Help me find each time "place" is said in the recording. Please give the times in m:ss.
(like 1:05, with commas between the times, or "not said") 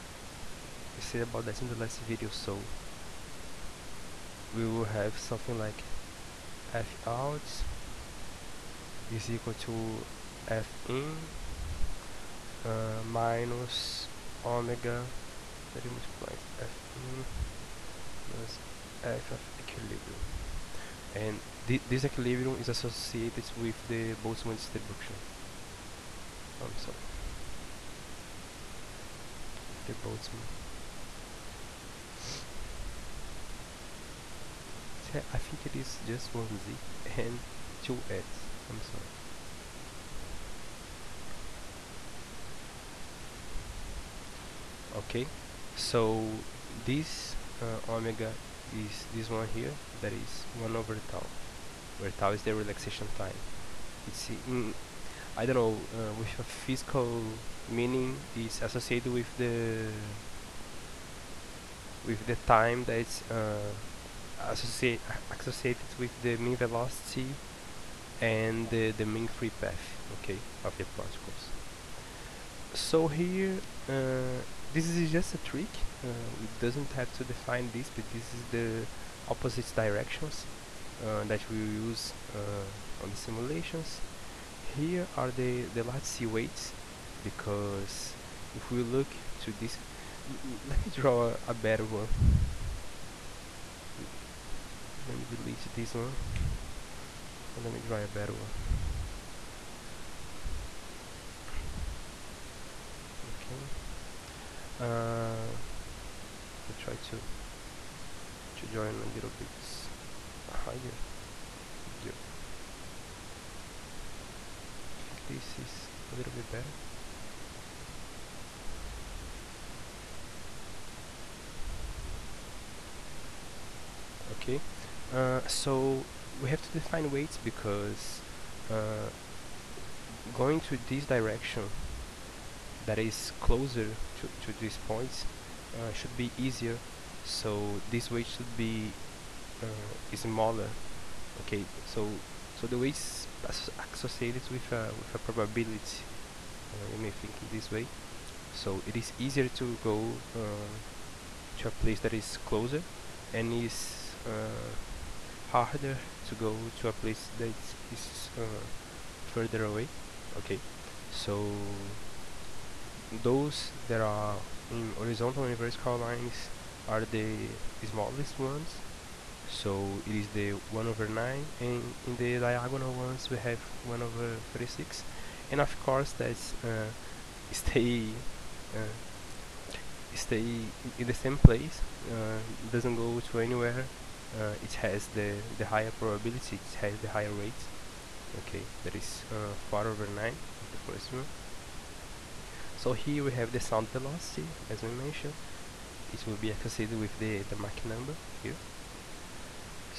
2:31, 2:36, 3:01.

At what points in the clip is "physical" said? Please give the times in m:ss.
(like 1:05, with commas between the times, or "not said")
0:56.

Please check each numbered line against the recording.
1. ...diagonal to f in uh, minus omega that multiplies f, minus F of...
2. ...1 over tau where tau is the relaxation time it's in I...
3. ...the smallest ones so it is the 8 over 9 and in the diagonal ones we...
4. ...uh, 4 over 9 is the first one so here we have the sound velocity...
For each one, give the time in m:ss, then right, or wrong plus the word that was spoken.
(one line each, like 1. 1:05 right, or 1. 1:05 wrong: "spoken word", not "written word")
1. 0:09 wrong: "equal", not "diagonal"
2. 0:50 right
3. 2:47 wrong: "1", not "8"
4. 3:09 right.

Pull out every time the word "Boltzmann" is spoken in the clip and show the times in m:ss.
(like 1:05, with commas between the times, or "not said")
0:24, 0:29.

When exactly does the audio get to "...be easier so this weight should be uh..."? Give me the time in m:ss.
2:16.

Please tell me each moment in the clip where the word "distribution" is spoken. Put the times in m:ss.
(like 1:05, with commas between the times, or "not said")
0:24.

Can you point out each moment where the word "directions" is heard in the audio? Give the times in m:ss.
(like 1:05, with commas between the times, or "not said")
1:19, 2:11.